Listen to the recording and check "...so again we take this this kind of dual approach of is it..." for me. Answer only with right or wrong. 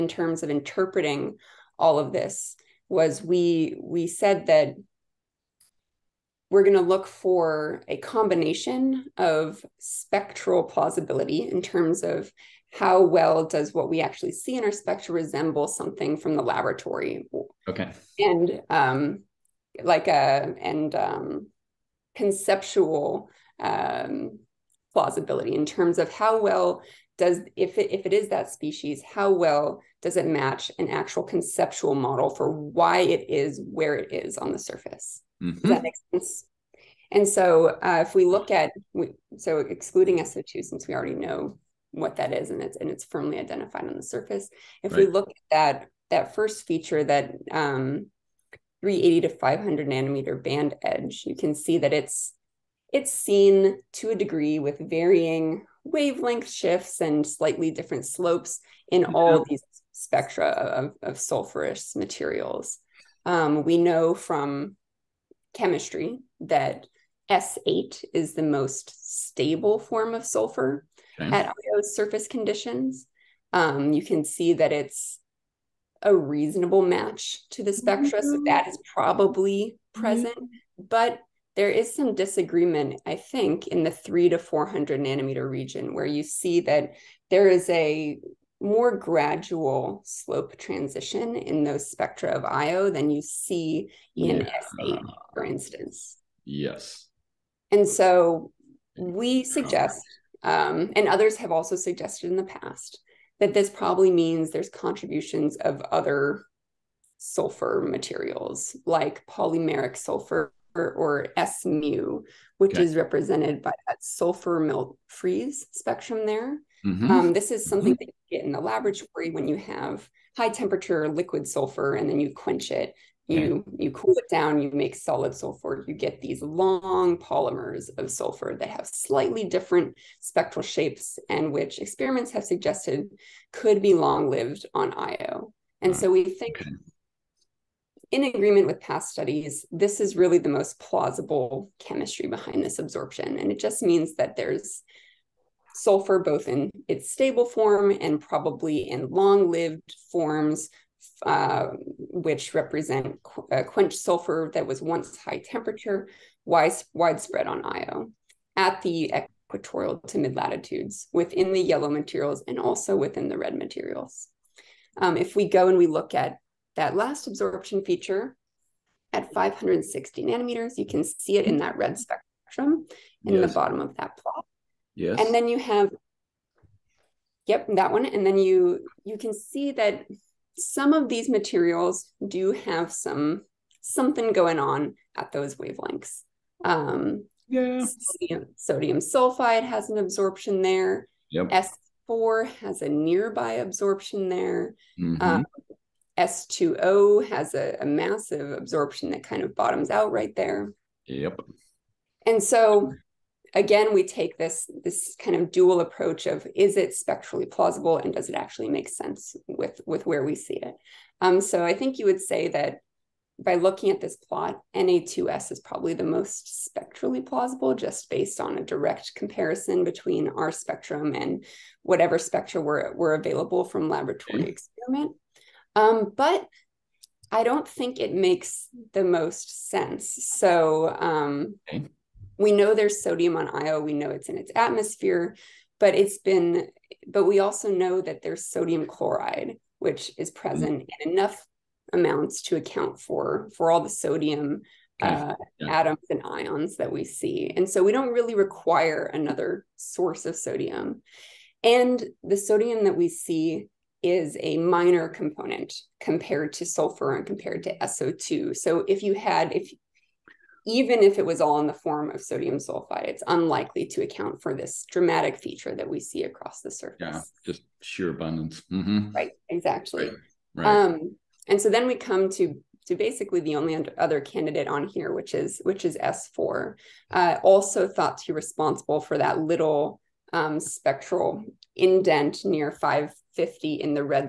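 right.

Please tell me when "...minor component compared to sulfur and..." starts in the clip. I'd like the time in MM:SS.
04:14.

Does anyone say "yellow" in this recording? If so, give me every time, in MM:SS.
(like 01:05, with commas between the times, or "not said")
02:41.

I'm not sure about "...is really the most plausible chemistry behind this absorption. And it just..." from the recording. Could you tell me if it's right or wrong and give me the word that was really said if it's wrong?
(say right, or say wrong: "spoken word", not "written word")
right.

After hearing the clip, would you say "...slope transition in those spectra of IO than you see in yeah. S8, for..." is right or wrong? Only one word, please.
right.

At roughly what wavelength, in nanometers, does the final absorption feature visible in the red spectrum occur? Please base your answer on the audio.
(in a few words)
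560.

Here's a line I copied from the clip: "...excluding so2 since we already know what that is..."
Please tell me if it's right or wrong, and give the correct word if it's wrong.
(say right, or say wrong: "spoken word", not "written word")
right.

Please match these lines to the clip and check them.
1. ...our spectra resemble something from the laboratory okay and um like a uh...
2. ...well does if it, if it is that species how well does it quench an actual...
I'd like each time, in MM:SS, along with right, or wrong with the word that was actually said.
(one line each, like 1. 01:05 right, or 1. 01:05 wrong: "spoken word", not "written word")
1. 00:14 right
2. 00:26 wrong: "match", not "quench".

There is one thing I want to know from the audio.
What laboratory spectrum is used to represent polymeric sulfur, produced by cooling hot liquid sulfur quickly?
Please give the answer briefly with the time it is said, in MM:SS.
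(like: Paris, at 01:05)
Sulfur melt freeze, at 01:53.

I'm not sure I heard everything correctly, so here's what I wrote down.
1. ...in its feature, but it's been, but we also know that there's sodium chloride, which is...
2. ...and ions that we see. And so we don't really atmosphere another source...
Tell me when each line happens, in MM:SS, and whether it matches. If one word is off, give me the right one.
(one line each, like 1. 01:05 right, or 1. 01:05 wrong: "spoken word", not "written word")
1. 03:54 wrong: "atmosphere", not "feature"
2. 04:06 wrong: "require", not "atmosphere".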